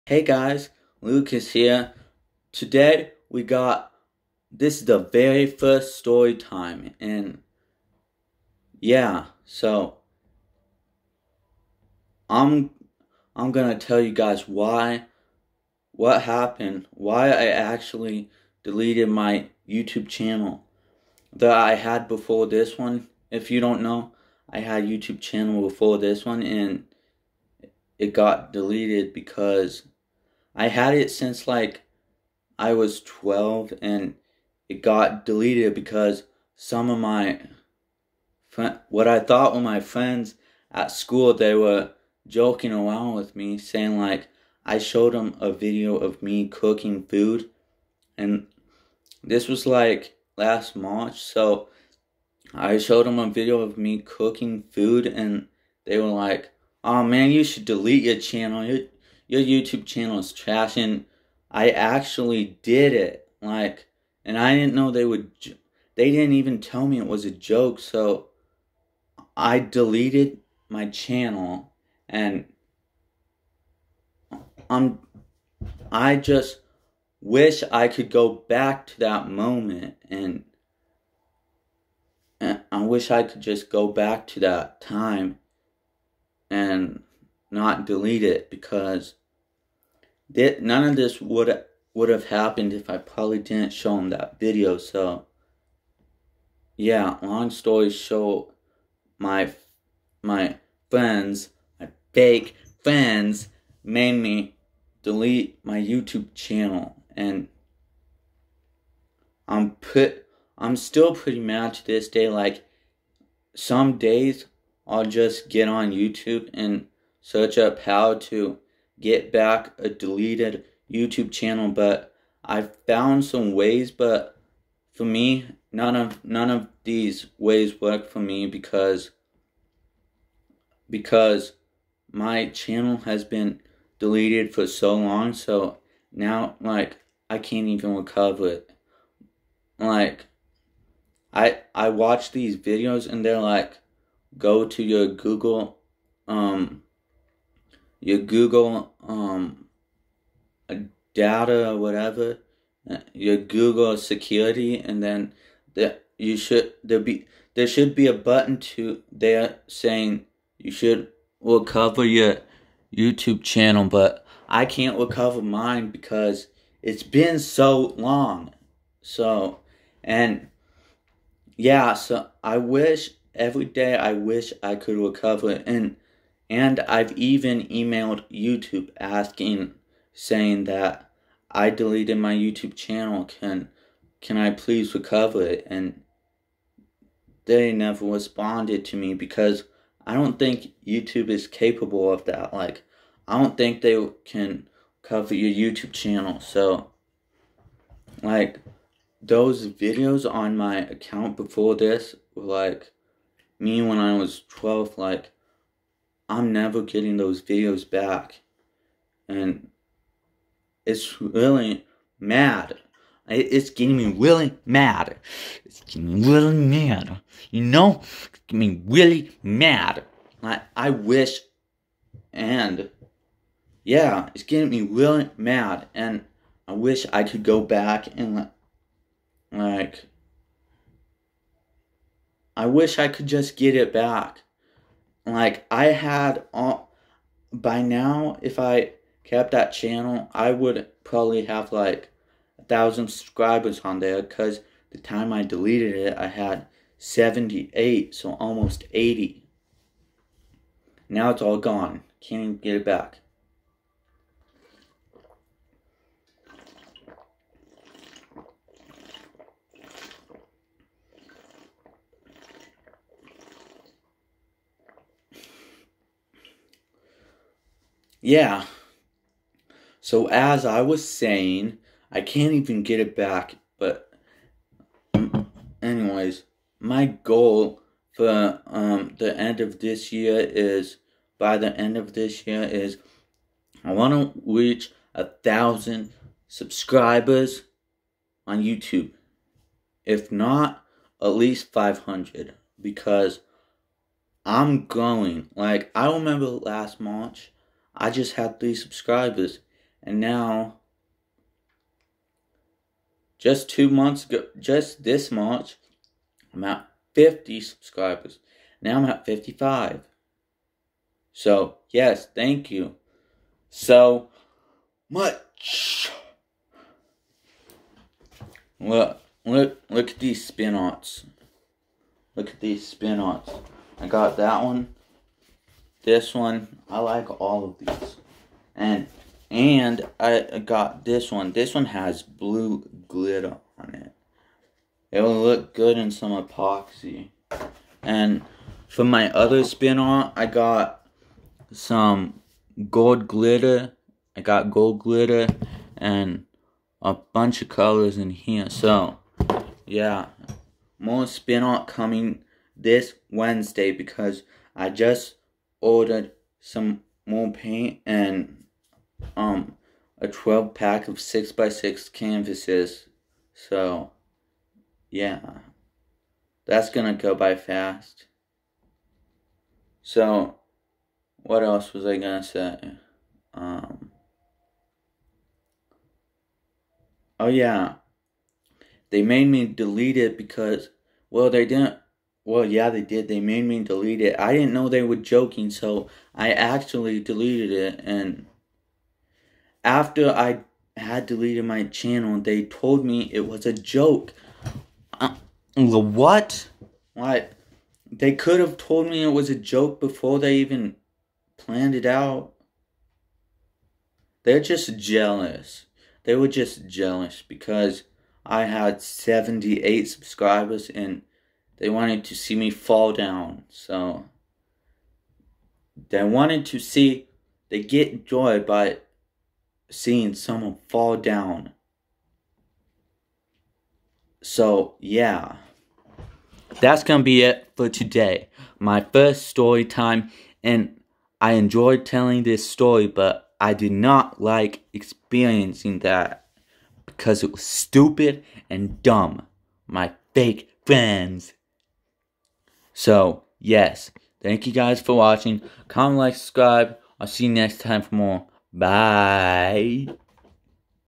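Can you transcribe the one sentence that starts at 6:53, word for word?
So they wanted to see, they get joy by seeing someone fall down.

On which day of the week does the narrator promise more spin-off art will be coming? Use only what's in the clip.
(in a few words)
Wednesday.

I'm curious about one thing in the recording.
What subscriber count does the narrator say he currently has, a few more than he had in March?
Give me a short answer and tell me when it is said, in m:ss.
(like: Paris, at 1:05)
55, at 5:09.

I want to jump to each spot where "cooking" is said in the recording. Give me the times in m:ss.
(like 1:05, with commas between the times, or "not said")
0:46, 0:53.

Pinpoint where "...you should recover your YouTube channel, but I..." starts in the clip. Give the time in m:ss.
2:40.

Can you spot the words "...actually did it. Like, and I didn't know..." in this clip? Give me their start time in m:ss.
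1:01.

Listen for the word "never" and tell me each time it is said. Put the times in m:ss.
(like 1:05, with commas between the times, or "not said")
3:07, 3:26.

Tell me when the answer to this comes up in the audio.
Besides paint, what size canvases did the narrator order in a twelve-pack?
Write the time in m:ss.
6:01.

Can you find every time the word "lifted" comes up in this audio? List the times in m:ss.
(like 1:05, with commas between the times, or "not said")
not said.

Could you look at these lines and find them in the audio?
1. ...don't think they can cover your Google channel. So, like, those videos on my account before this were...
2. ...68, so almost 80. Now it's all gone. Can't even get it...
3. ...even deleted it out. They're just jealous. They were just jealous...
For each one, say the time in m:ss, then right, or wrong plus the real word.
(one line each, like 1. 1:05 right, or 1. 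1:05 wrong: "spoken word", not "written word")
1. 3:13 wrong: "YouTube", not "Google"
2. 4:06 wrong: "78", not "68"
3. 6:40 wrong: "planned", not "deleted".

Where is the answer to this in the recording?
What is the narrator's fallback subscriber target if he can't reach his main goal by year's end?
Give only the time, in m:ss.
4:51.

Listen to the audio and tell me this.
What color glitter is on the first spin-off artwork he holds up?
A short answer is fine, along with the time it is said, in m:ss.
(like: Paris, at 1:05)
blue, at 5:32.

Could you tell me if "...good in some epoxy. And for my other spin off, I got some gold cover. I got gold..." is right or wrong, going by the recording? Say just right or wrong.
wrong.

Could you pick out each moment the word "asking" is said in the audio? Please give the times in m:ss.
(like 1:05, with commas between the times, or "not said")
2:58.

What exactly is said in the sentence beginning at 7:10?
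And I enjoyed telling this story, but I did not like experiencing that because it was stupid and dumb.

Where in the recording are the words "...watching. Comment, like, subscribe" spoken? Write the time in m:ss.
7:25.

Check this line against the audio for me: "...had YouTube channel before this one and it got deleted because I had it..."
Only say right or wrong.
right.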